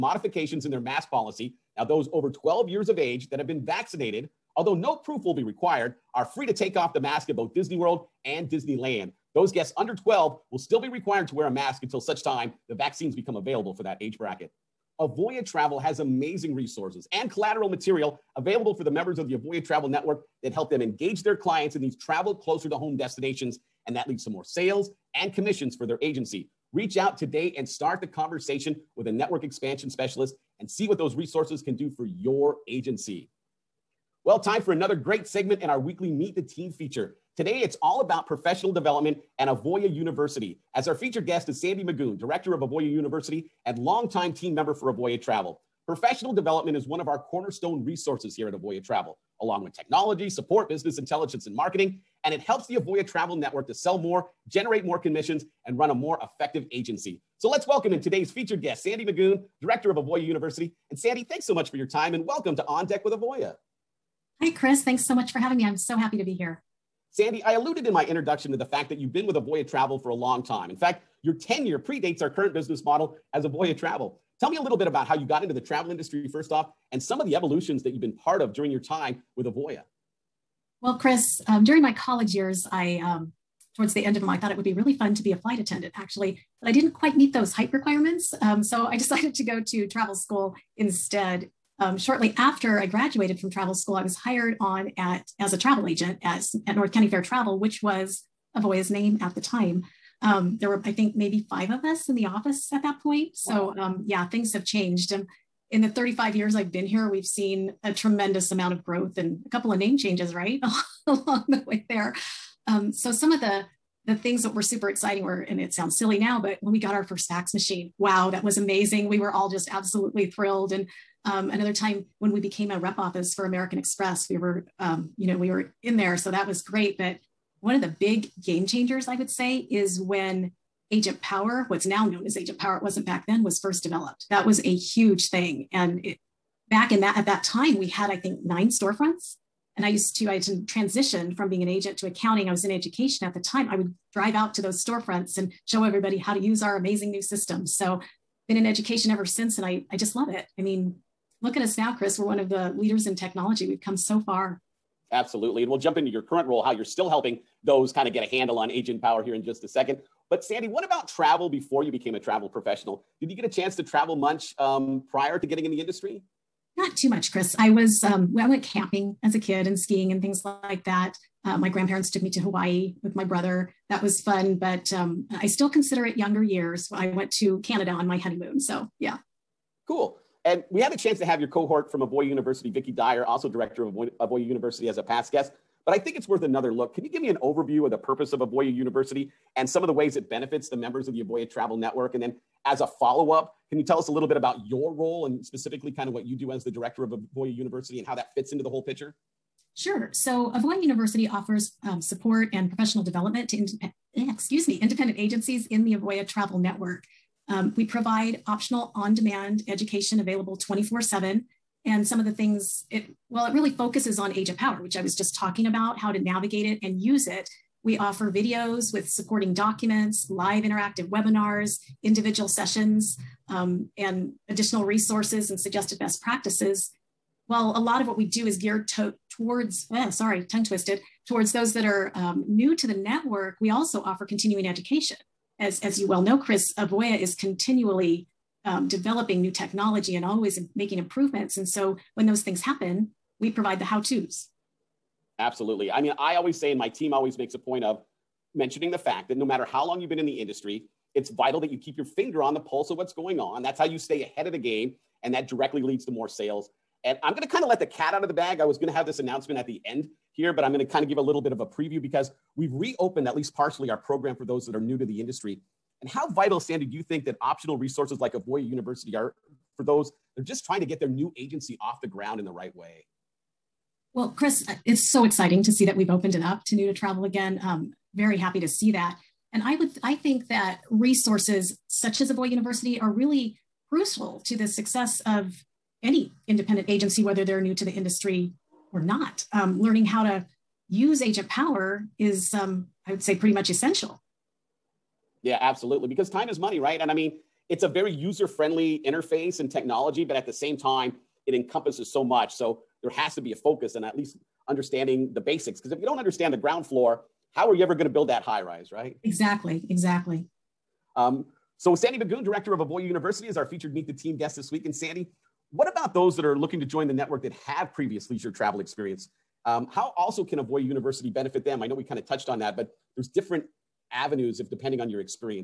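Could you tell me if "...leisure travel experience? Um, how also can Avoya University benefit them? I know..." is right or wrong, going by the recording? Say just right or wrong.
right.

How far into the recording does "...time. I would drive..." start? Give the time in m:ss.
2:23.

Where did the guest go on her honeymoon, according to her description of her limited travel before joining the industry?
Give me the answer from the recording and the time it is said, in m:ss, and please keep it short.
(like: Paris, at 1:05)
Canada, at 2:57.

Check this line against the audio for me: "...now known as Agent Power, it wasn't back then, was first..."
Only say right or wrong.
right.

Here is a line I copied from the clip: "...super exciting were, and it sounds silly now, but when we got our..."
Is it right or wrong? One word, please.
right.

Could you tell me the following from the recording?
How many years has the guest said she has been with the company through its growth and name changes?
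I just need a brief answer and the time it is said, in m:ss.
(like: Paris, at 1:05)
35, at 1:45.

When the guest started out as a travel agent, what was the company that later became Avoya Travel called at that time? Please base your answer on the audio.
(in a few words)
North County Fair Travel.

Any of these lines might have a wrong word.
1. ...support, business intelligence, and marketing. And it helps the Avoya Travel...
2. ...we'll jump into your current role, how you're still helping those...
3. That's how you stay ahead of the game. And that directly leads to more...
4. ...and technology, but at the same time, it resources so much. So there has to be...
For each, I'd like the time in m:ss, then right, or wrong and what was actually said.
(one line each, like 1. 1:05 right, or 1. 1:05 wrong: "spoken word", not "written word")
1. 0:50 right
2. 2:35 right
3. 4:13 right
4. 4:59 wrong: "encompasses", not "resources".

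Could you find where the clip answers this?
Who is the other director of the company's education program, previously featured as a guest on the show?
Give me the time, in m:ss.
3:02.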